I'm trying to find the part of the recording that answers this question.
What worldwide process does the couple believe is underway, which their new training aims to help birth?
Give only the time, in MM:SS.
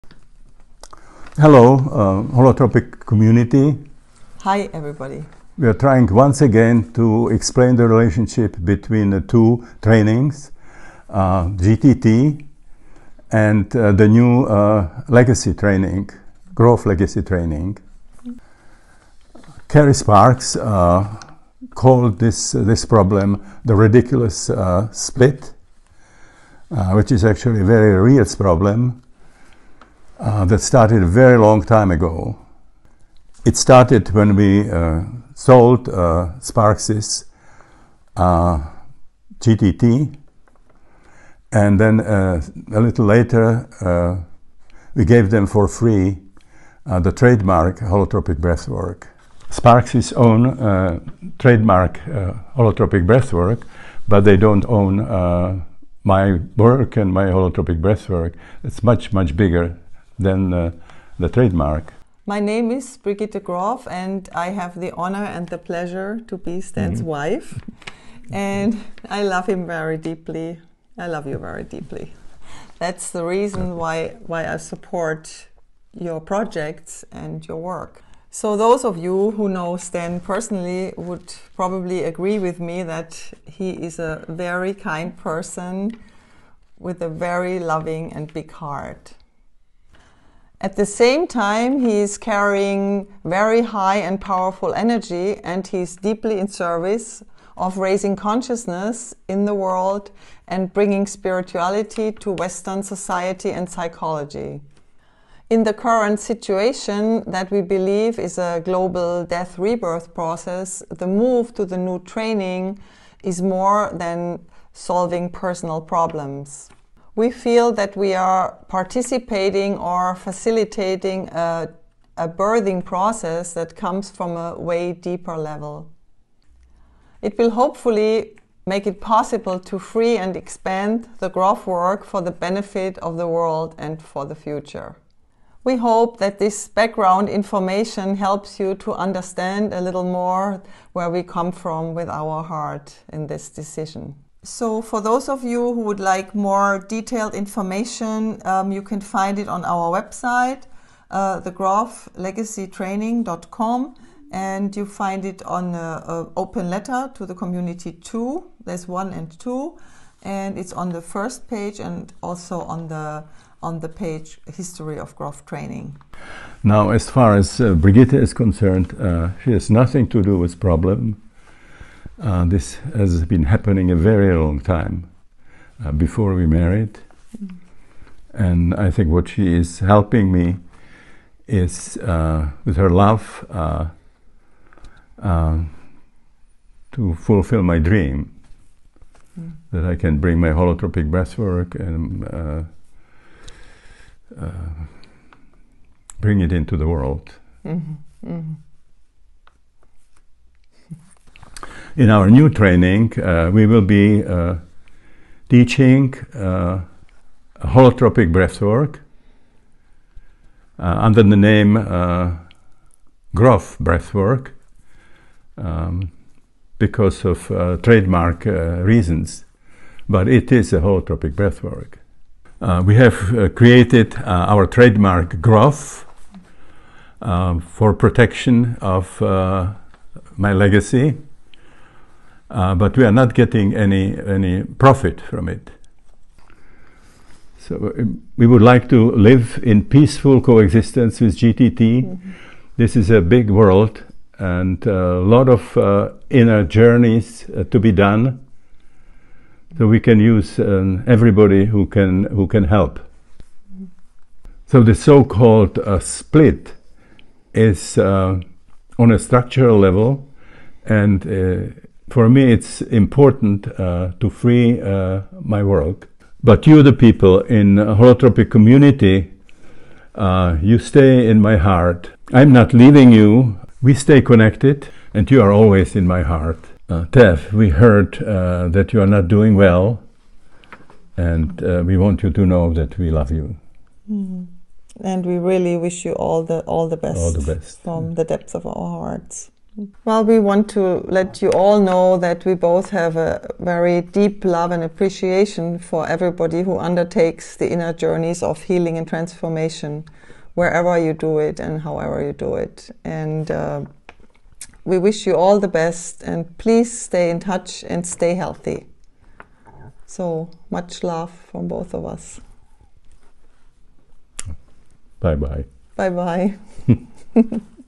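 01:48.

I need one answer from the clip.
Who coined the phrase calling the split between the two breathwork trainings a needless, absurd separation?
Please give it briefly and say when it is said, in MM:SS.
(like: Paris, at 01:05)
Cary Sparks, at 00:19.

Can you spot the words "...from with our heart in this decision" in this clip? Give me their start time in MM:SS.
02:21.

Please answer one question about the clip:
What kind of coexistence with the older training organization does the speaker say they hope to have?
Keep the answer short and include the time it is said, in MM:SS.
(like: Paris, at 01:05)
Peaceful coexistence, at 03:59.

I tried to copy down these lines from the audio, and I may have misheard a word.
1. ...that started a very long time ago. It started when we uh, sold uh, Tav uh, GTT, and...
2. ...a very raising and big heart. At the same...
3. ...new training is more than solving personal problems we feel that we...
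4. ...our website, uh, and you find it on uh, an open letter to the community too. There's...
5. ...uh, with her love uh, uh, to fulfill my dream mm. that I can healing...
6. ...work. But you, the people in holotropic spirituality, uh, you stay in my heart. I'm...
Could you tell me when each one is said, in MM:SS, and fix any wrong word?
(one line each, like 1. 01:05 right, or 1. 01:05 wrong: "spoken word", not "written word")
1. 00:30 wrong: "Sparksys", not "Tav"
2. 01:27 wrong: "loving", not "raising"
3. 01:51 right
4. 02:29 right
5. 03:01 wrong: "bring", not "healing"
6. 04:25 wrong: "community", not "spirituality".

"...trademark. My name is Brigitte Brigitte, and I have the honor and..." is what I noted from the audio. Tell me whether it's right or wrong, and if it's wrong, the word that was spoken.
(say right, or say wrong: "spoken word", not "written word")
wrong: "Grof", not "Brigitte".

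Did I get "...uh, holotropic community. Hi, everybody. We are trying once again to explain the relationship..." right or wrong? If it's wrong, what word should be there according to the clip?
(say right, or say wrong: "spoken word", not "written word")
right.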